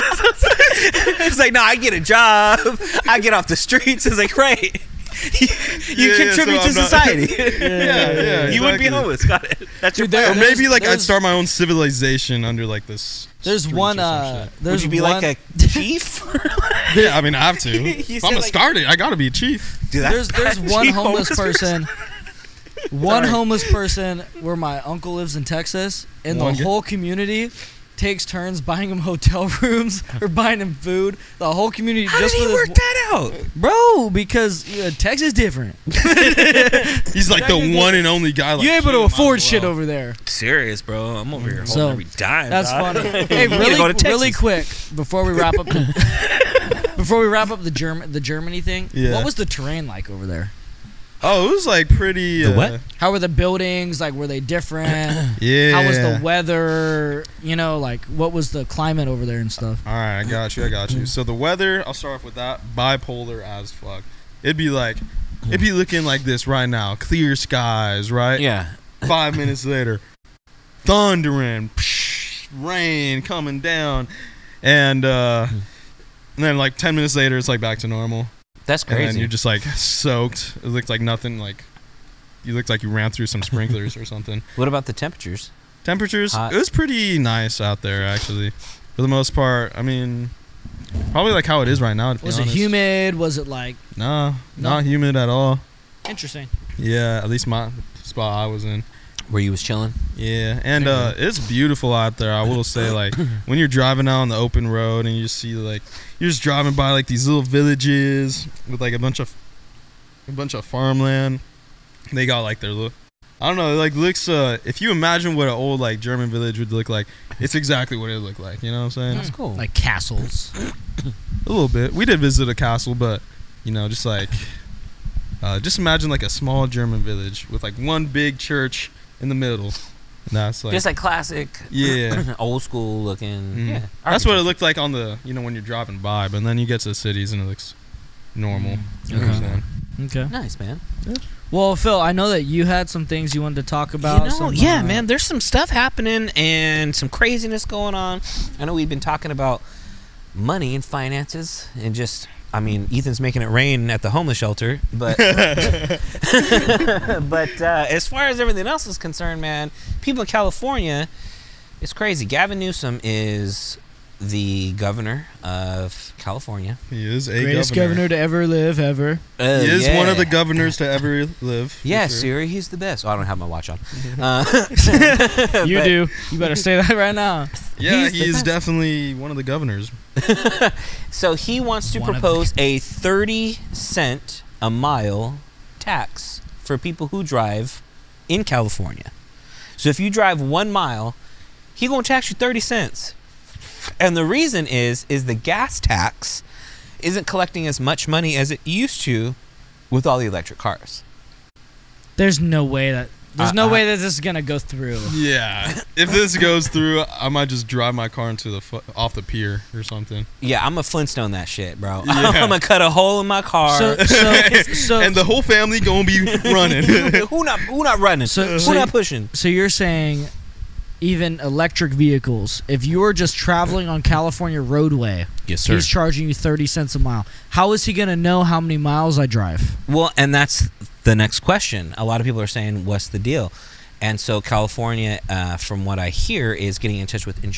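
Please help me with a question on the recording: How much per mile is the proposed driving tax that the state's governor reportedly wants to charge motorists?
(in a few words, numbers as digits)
30 cents.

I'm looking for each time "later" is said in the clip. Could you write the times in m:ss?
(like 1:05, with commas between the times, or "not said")
1:09, 1:17.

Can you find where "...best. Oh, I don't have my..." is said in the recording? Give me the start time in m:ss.
2:52.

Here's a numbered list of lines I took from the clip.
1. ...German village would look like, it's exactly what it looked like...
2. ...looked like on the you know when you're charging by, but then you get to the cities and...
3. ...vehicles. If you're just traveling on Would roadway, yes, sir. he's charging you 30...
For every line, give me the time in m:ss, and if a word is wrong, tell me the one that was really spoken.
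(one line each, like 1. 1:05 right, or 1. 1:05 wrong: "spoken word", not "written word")
1. 1:56 right
2. 2:14 wrong: "driving", not "charging"
3. 3:41 wrong: "California", not "Would".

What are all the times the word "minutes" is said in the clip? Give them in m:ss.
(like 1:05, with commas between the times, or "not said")
1:09, 1:16.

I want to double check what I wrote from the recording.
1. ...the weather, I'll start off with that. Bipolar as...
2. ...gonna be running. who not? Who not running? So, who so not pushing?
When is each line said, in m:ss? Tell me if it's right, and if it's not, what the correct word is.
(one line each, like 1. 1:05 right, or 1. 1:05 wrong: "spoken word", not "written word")
1. 1:01 right
2. 3:35 right.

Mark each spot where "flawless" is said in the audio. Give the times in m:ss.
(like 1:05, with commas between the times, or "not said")
not said.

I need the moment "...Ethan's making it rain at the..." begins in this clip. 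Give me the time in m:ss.
2:32.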